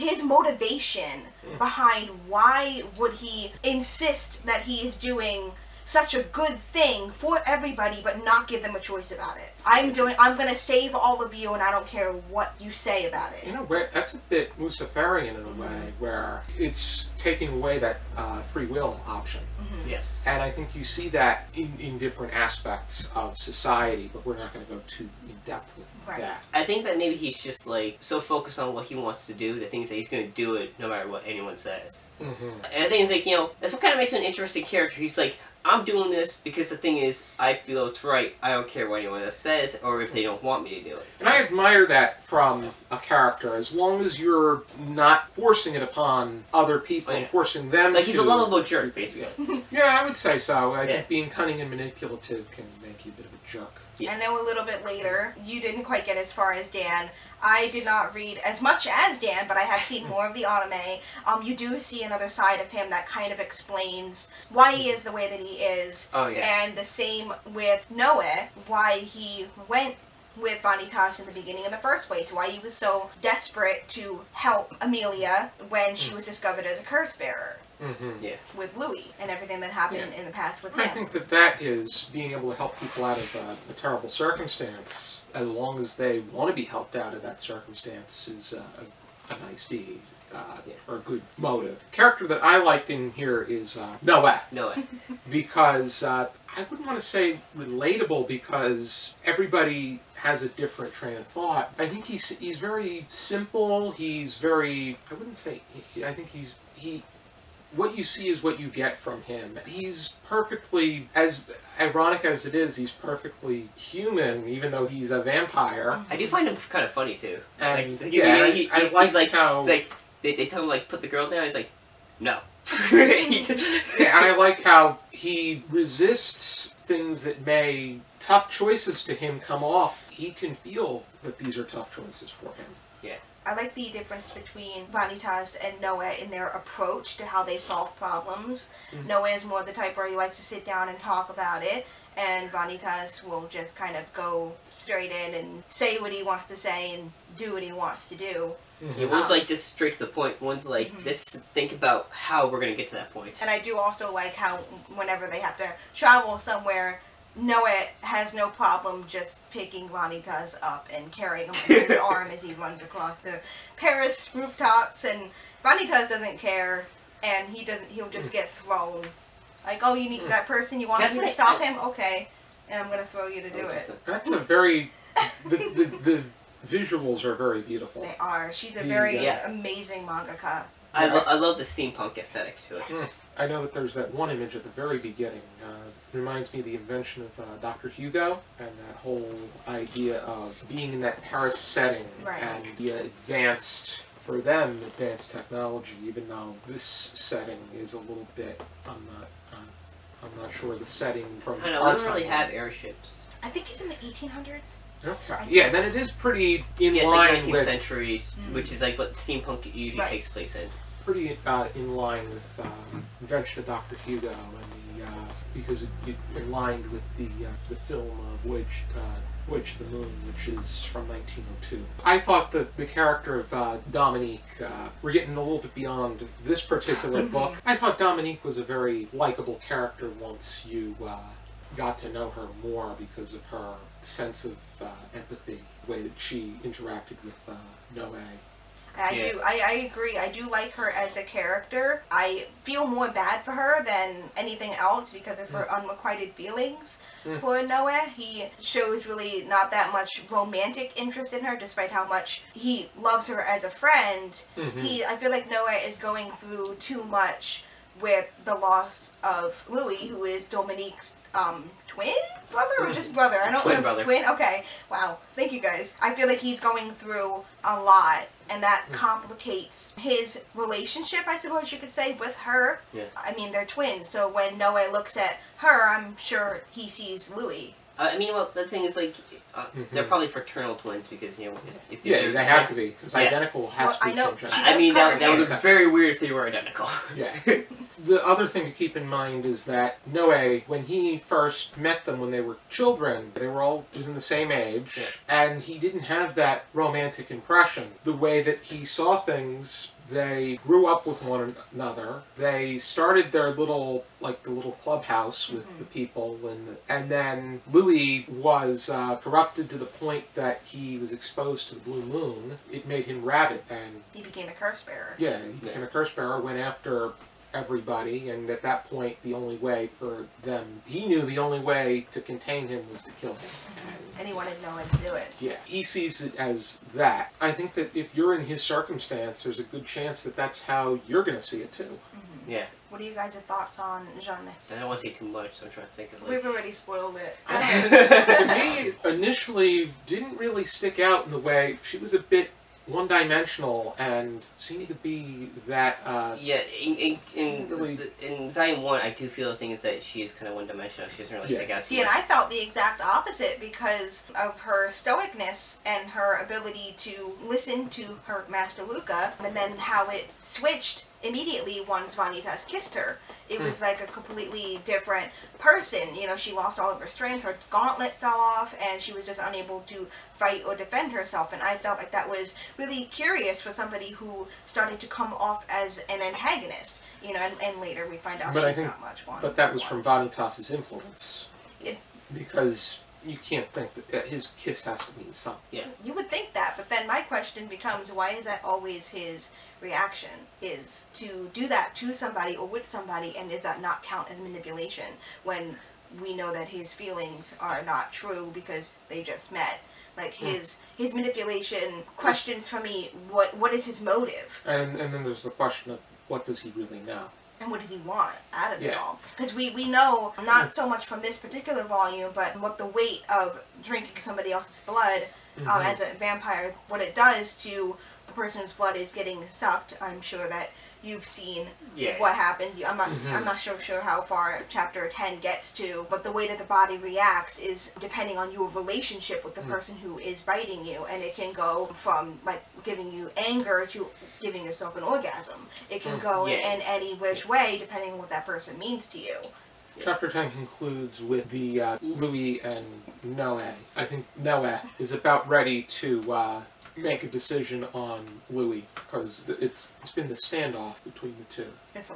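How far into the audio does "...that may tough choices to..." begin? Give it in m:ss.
2:07.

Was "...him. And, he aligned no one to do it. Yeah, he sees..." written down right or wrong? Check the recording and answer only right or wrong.
wrong.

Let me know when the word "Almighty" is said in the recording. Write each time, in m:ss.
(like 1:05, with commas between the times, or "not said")
not said.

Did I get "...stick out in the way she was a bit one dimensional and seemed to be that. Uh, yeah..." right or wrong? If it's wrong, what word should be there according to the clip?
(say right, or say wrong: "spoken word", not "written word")
right.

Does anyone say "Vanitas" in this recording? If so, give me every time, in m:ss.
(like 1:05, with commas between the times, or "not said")
1:10, 2:14, 2:22, 2:39, 2:45, 6:02, 6:20.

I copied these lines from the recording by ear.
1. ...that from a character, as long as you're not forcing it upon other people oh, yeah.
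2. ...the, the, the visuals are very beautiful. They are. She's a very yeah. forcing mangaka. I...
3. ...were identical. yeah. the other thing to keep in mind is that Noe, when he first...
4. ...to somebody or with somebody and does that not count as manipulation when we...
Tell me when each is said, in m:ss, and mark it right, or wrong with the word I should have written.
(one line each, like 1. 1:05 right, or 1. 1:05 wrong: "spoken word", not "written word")
1. 0:41 right
2. 2:55 wrong: "amazing", not "forcing"
3. 4:46 right
4. 6:31 right.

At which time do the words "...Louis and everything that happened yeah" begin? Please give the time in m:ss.
1:18.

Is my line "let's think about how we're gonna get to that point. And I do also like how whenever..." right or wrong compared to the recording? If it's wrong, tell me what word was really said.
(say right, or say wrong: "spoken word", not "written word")
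right.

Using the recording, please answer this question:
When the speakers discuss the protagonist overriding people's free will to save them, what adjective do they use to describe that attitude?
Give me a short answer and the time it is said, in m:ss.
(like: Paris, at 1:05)
Luciferian, at 0:14.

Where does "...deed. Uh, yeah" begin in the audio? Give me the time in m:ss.
1:29.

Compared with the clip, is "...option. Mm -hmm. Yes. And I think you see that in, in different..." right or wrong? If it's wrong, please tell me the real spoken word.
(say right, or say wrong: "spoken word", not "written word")
right.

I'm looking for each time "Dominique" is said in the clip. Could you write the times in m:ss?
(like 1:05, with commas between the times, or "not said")
3:43, 3:47, 4:20.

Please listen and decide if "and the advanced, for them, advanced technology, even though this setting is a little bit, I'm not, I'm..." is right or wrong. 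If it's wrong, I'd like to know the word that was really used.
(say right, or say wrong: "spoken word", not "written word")
right.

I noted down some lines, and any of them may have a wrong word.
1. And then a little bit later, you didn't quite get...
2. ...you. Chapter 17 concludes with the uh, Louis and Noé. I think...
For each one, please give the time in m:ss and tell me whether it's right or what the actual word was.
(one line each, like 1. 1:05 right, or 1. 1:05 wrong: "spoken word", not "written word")
1. 0:54 right
2. 7:19 wrong: "10", not "17".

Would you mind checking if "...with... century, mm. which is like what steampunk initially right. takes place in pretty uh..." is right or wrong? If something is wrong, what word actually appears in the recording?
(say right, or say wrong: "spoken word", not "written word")
wrong: "usually", not "initially".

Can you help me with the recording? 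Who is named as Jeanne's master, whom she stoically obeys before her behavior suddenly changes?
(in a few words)
Luca.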